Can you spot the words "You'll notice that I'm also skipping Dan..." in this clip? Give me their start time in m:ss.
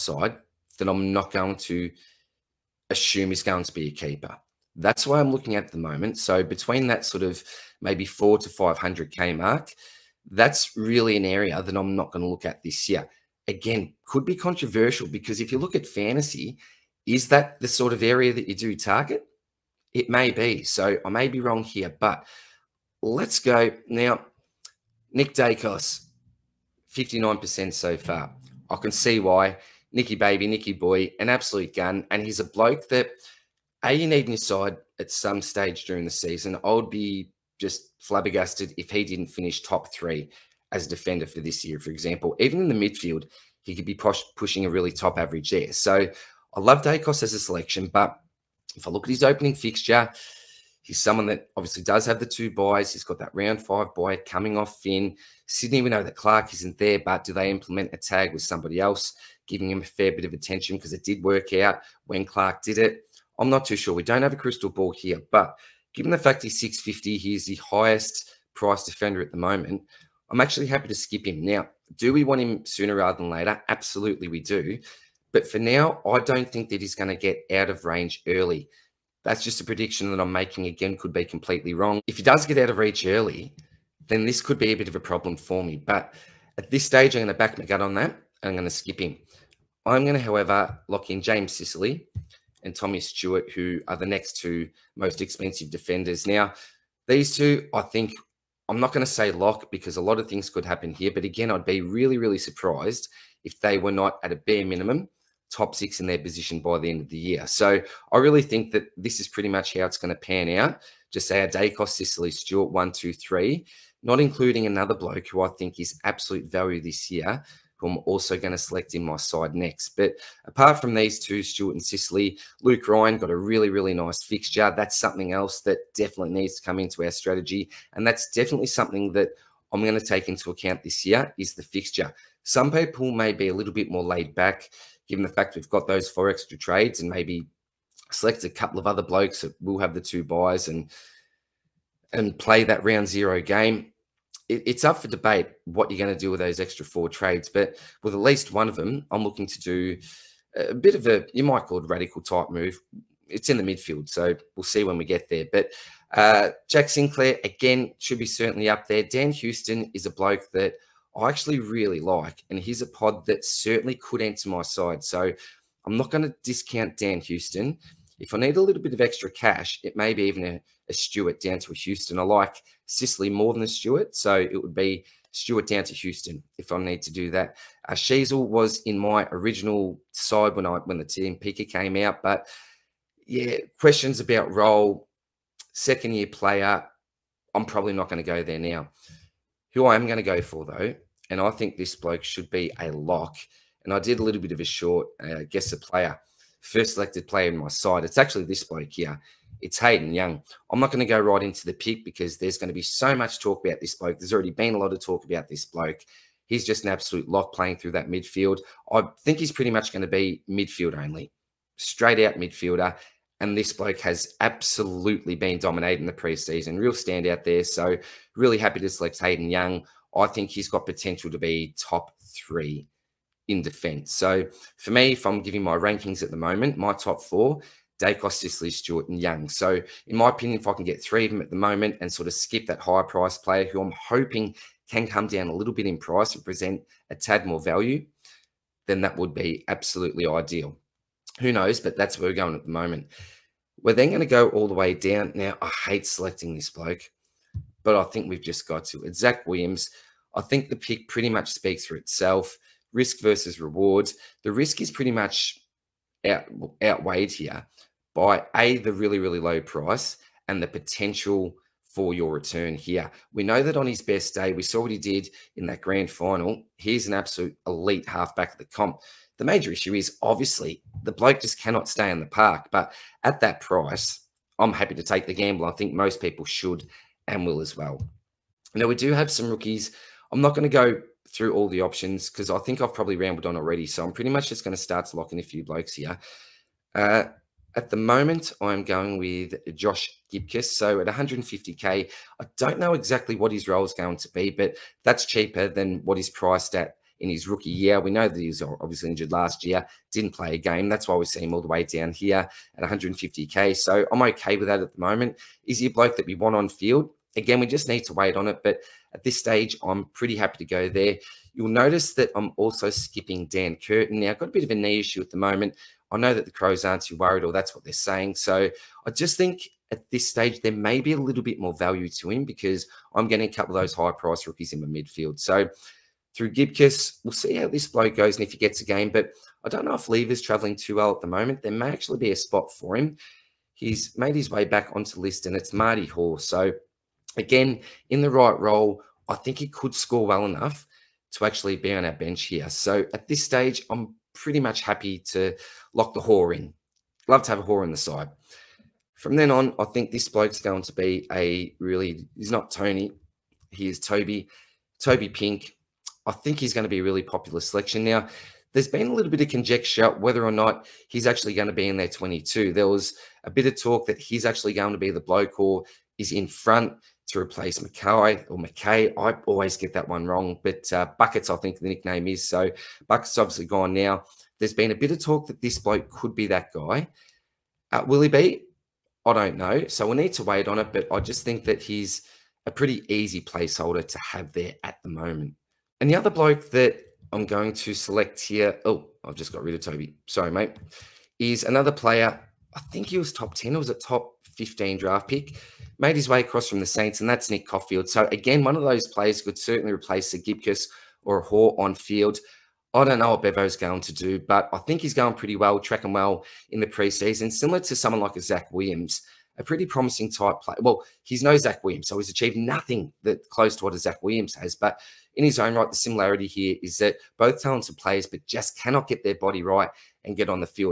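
5:11.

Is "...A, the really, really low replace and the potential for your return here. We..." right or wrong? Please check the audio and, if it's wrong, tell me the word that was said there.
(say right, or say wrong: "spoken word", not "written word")
wrong: "price", not "replace".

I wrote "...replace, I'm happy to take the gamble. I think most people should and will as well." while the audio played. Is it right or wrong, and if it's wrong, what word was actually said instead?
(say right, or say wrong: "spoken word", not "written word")
wrong: "price", not "replace".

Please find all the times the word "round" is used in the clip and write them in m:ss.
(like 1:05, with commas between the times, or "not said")
0:53, 2:22.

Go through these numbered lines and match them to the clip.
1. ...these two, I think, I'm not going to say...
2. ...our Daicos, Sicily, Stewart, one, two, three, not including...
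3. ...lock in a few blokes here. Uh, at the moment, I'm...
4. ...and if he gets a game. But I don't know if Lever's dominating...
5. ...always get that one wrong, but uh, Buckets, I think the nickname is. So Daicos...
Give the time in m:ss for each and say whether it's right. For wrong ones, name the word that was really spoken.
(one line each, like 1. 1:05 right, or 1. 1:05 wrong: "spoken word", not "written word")
1. 1:37 right
2. 1:51 right
3. 4:45 right
4. 5:28 wrong: "traveling", not "dominating"
5. 6:09 wrong: "Buckets", not "Daicos".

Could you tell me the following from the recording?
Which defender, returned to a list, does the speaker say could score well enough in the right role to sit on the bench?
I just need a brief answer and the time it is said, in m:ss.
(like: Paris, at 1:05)
Marty Hore, at 5:35.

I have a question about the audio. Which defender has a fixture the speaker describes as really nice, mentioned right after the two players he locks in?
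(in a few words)
Luke Ryan.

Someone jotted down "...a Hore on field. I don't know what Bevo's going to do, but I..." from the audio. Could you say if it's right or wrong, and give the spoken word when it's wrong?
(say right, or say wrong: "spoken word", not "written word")
right.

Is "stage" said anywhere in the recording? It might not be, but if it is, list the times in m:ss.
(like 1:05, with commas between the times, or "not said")
0:35, 1:26, 5:09, 5:20, 5:43.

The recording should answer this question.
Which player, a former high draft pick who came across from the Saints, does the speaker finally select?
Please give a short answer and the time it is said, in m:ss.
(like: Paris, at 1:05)
Nick Coffield, at 6:37.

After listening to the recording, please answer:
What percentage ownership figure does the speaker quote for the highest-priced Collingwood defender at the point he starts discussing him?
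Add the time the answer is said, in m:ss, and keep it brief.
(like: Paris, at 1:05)
59%, at 0:26.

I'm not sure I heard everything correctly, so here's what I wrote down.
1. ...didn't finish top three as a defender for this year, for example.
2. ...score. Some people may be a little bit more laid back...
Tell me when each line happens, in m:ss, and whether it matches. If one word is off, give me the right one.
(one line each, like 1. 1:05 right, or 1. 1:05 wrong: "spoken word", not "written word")
1. 0:39 right
2. 2:11 wrong: "fixture", not "score".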